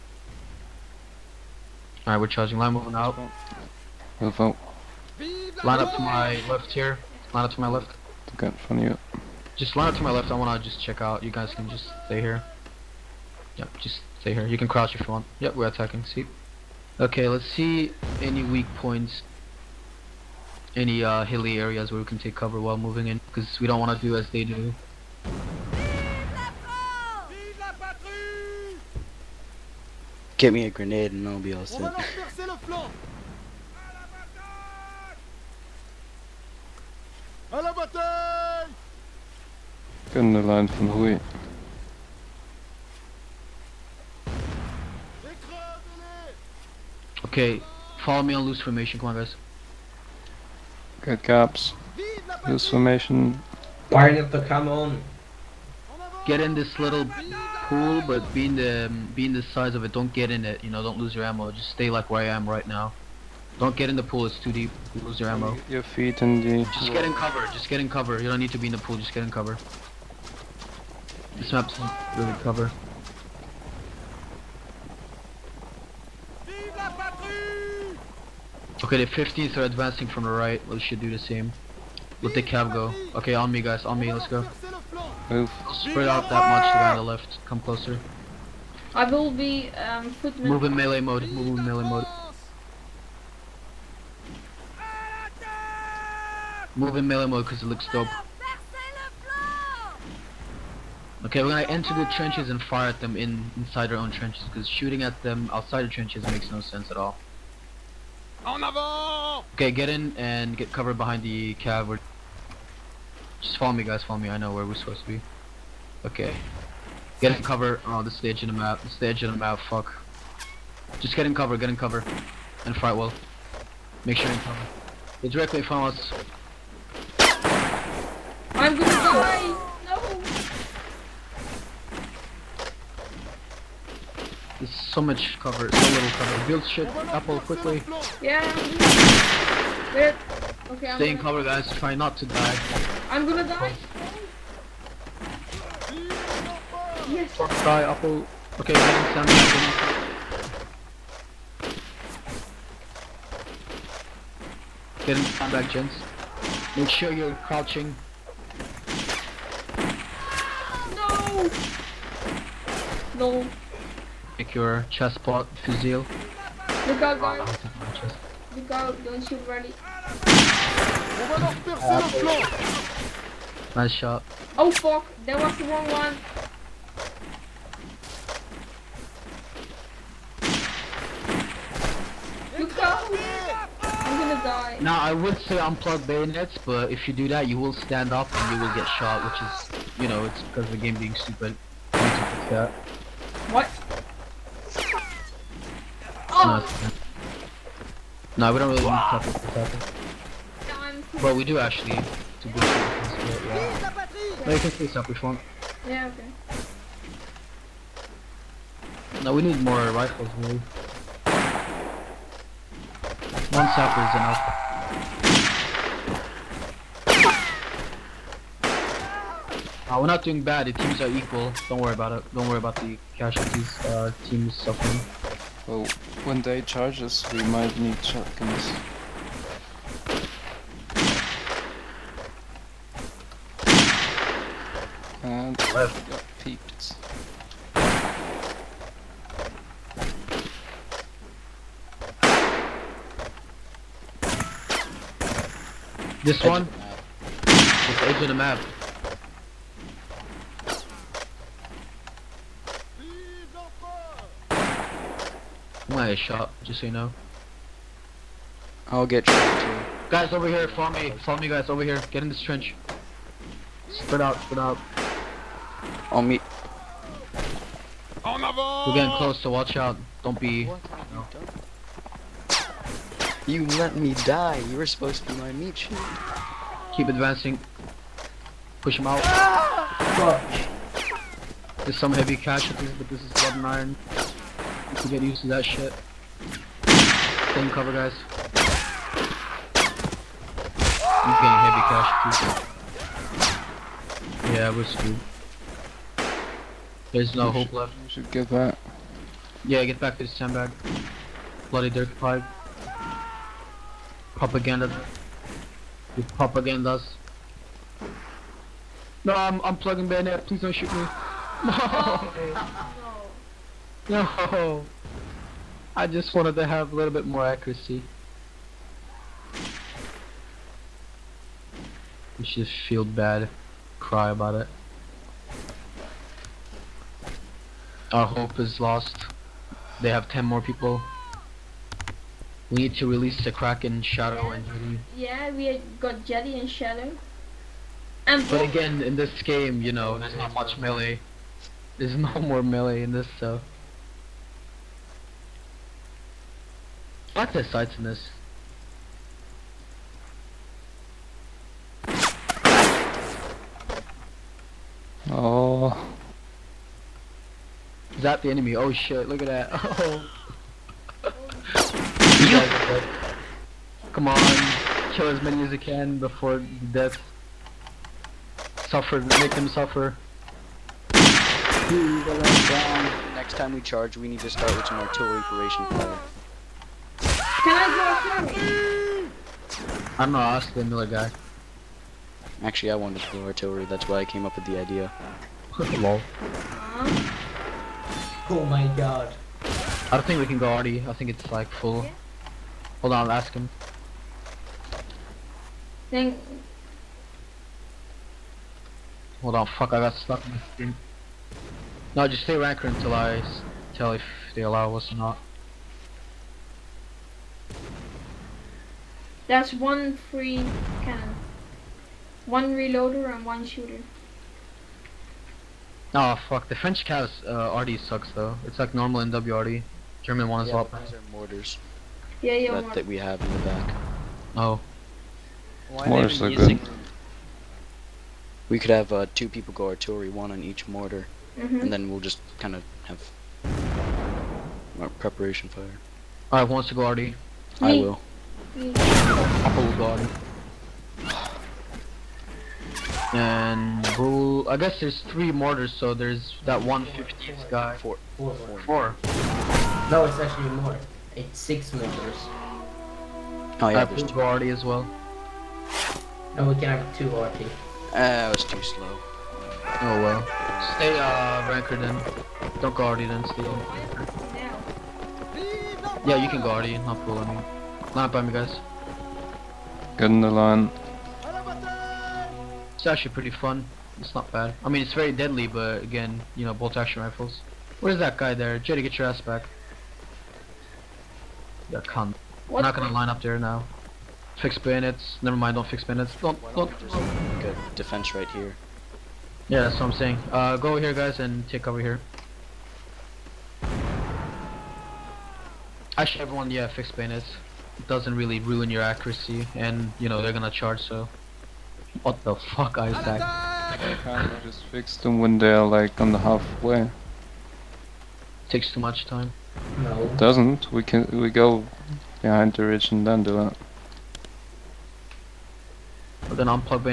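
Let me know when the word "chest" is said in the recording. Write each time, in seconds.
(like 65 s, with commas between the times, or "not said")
164 s.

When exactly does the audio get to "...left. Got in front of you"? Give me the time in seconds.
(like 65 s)
7 s.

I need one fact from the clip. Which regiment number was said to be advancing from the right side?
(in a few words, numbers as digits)
15th.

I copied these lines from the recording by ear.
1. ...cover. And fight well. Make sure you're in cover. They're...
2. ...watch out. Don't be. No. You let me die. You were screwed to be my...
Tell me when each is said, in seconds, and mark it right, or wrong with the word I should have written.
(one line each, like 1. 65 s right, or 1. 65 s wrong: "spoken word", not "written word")
1. 121 s right
2. 269 s wrong: "supposed", not "screwed".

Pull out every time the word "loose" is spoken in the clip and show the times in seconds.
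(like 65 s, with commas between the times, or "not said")
48 s, 52 s.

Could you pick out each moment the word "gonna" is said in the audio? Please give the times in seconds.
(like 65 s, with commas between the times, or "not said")
101 s, 128 s, 143 s, 184 s, 255 s, 482 s, 500 s, 516 s.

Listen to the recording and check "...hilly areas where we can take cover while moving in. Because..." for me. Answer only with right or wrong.
right.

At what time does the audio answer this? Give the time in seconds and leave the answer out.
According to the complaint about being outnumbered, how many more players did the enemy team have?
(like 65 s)
330 s.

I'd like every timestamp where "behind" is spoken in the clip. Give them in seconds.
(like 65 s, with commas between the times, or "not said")
110 s, 512 s.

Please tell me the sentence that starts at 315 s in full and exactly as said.
I just wanted to have a little bit more accuracy.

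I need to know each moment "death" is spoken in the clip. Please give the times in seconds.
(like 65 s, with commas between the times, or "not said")
366 s.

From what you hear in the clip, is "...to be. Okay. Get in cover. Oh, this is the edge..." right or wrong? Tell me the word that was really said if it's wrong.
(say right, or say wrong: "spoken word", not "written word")
right.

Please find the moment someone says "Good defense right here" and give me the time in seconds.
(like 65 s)
487 s.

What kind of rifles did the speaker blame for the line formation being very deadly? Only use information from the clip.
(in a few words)
bolt action rifles.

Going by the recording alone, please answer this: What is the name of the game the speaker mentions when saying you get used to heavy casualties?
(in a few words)
Blood and Iron.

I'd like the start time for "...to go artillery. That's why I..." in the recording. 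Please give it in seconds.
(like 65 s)
383 s.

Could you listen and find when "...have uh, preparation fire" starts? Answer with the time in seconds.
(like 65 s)
433 s.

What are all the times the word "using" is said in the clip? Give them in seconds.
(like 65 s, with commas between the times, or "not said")
426 s.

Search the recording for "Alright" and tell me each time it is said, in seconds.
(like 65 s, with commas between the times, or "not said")
2 s, 436 s.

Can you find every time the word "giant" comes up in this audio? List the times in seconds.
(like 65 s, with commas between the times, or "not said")
not said.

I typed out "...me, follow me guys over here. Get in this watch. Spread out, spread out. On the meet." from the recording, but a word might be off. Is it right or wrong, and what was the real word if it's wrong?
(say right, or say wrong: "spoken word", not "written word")
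wrong: "trench", not "watch".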